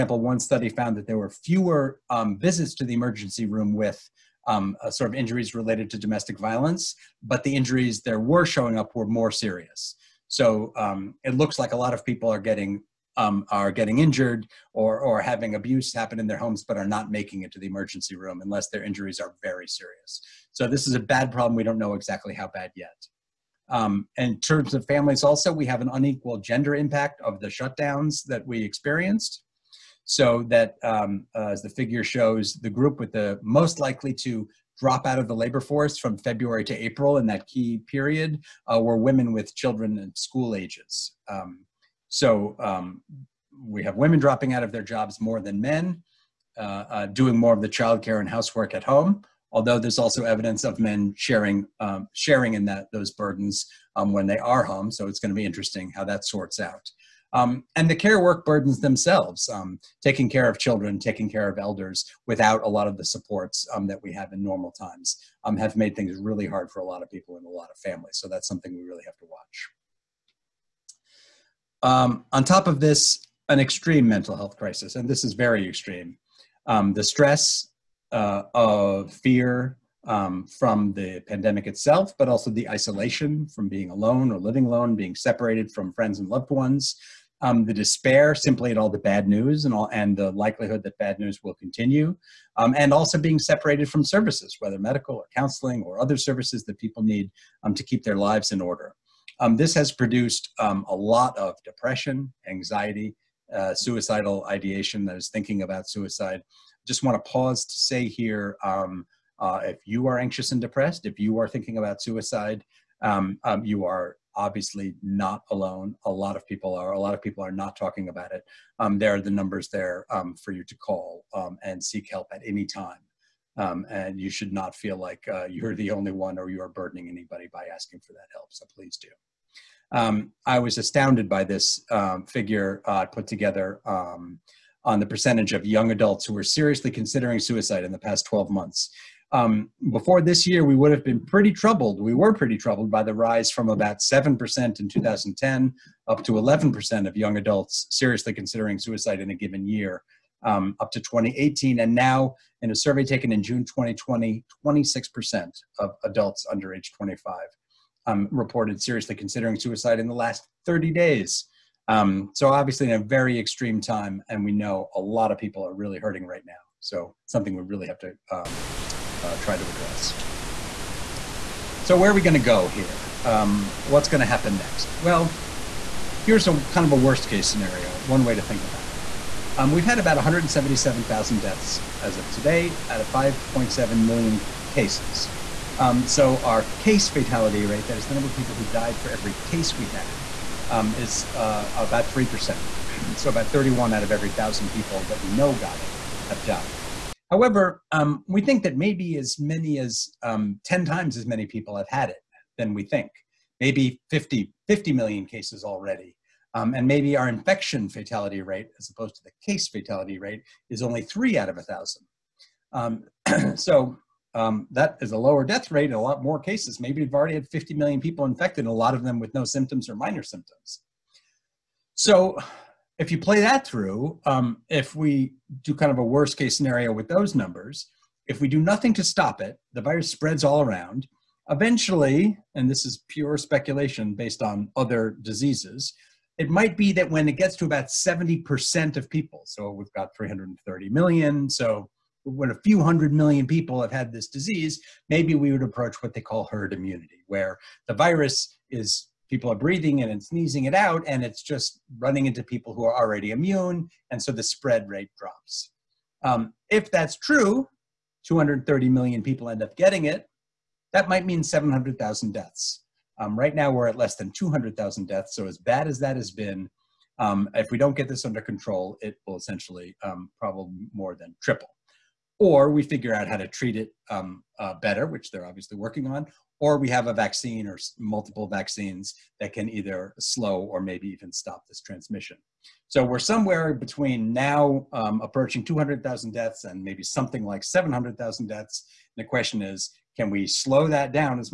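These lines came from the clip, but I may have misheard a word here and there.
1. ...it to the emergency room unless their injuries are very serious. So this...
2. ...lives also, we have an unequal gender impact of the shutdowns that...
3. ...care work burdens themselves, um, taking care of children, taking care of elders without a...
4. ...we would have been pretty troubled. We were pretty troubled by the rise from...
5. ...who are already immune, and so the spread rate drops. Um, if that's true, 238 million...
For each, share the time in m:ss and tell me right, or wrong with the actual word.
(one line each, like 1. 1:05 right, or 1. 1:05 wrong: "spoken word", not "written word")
1. 0:17 right
2. 0:24 wrong: "families", not "lives"
3. 0:57 right
4. 2:20 right
5. 4:12 wrong: "230", not "238".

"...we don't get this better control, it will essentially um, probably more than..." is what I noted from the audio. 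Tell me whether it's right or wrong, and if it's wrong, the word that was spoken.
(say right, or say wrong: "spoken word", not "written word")
wrong: "under", not "better".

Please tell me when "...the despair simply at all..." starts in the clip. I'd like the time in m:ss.
1:27.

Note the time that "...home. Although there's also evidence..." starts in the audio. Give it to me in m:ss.
0:48.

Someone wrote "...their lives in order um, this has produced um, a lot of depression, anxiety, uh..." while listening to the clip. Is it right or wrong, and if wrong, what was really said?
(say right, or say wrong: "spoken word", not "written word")
right.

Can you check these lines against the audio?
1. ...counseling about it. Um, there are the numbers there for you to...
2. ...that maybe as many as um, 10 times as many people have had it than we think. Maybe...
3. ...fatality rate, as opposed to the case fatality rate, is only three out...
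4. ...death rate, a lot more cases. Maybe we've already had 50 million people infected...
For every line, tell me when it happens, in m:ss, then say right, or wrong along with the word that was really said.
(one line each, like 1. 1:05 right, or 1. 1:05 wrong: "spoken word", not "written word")
1. 1:57 wrong: "talking", not "counseling"
2. 3:18 right
3. 3:27 right
4. 3:35 right.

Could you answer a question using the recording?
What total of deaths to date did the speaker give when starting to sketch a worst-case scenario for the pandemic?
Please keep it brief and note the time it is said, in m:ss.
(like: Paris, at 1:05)
177,000, at 3:00.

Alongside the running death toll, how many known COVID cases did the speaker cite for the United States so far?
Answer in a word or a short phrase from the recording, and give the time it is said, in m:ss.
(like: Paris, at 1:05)
5.7 million, at 3:03.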